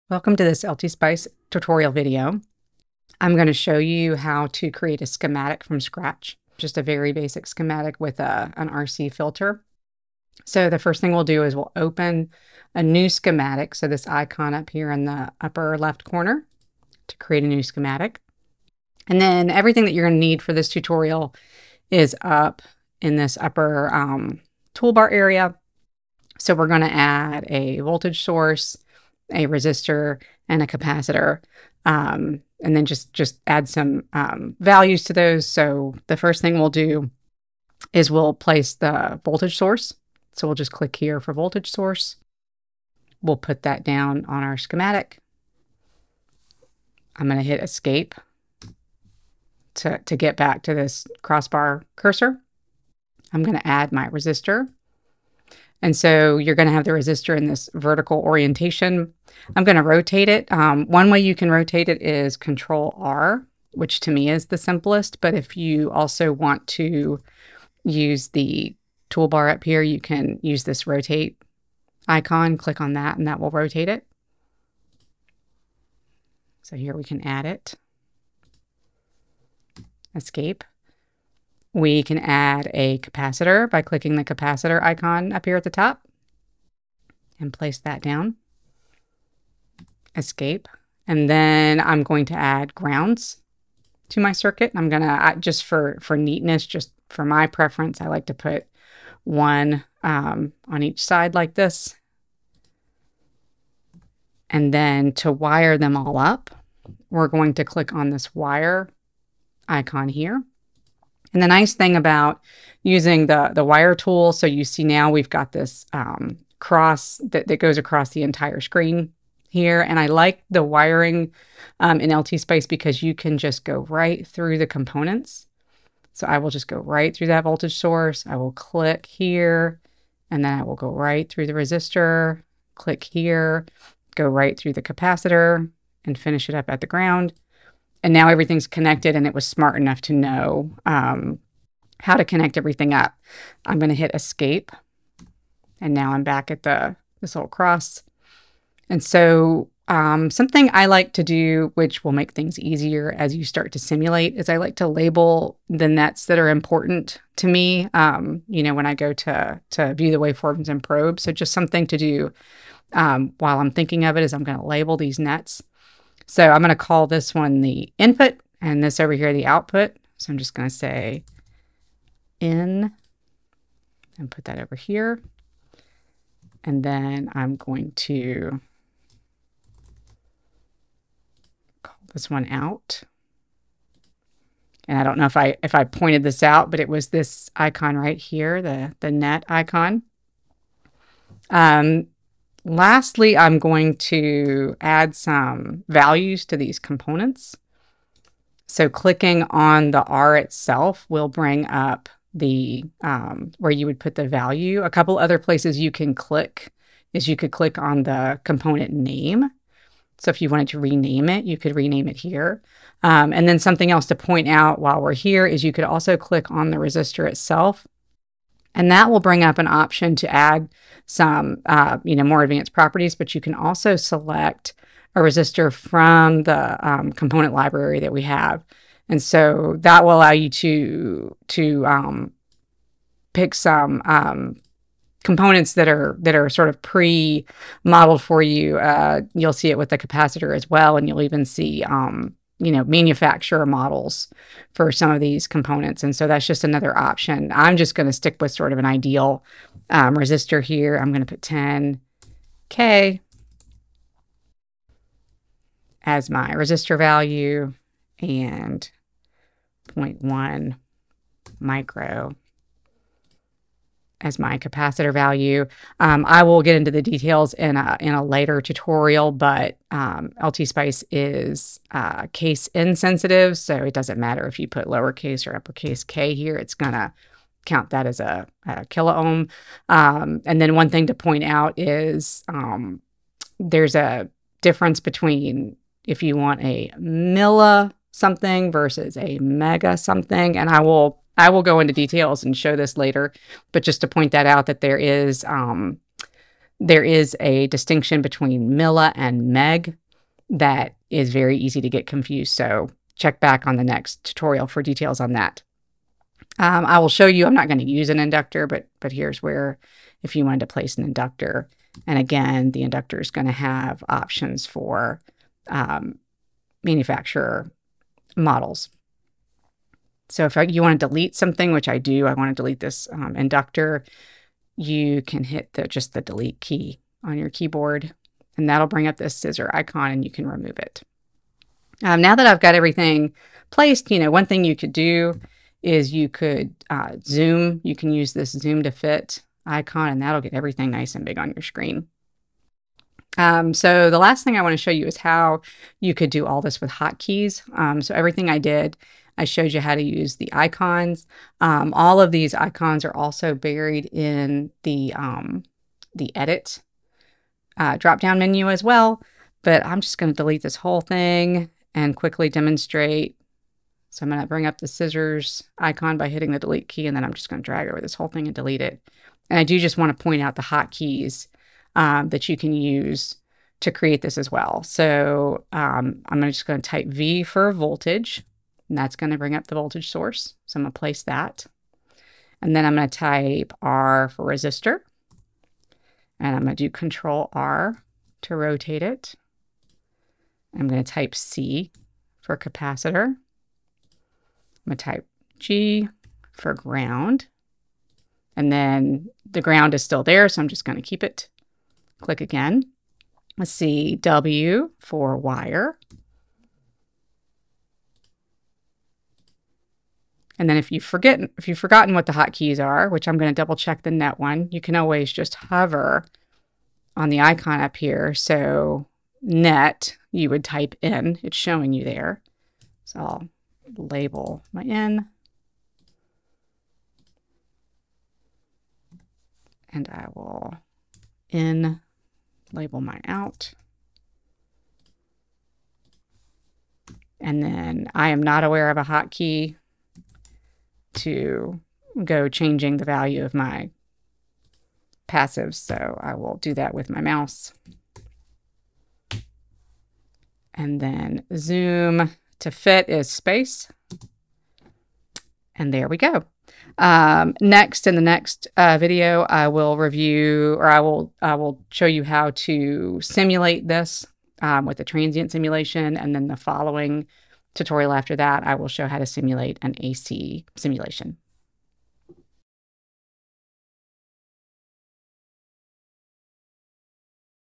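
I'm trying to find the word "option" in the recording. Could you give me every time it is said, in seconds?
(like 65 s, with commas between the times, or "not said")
219 s, 246 s, 314 s.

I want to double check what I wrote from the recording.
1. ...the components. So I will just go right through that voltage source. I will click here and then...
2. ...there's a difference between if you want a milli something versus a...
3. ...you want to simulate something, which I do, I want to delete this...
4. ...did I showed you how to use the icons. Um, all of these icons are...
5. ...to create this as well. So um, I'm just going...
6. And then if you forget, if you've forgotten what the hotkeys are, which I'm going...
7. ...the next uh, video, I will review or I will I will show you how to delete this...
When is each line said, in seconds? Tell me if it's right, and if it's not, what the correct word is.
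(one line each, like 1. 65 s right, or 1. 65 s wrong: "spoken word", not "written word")
1. 124 s right
2. 283 s right
3. 320 s wrong: "delete", not "simulate"
4. 348 s right
5. 373 s right
6. 410 s right
7. 458 s wrong: "simulate", not "delete".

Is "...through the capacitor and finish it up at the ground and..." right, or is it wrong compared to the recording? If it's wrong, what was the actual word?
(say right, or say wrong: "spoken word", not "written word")
right.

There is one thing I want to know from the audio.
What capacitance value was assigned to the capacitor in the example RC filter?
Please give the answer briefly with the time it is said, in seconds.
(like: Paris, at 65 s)
0.1 micro, at 259 s.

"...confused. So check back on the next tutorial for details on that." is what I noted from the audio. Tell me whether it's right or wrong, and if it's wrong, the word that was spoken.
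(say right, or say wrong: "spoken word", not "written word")
right.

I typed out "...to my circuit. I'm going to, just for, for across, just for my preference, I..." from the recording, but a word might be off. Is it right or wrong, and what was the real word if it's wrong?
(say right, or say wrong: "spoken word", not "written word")
wrong: "neatness", not "across".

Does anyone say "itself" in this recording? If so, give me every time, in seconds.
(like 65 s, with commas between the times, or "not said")
200 s, 217 s.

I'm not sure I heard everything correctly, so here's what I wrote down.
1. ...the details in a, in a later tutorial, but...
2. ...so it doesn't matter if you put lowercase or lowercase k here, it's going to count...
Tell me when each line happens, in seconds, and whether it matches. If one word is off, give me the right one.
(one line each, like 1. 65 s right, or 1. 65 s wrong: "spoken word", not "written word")
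1. 266 s right
2. 273 s wrong: "uppercase", not "lowercase".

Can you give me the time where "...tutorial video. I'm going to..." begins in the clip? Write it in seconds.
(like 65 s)
1 s.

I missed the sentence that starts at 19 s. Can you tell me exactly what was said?
And then everything that you're going to need for this tutorial is up in this upper um, toolbar area.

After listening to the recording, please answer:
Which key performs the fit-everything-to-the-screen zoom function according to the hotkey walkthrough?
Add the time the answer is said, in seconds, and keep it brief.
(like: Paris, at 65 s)
Space, at 453 s.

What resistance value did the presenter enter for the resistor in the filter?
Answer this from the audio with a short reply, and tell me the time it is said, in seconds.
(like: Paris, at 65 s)
10k, at 251 s.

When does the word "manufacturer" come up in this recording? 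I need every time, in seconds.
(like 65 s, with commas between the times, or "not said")
242 s, 316 s.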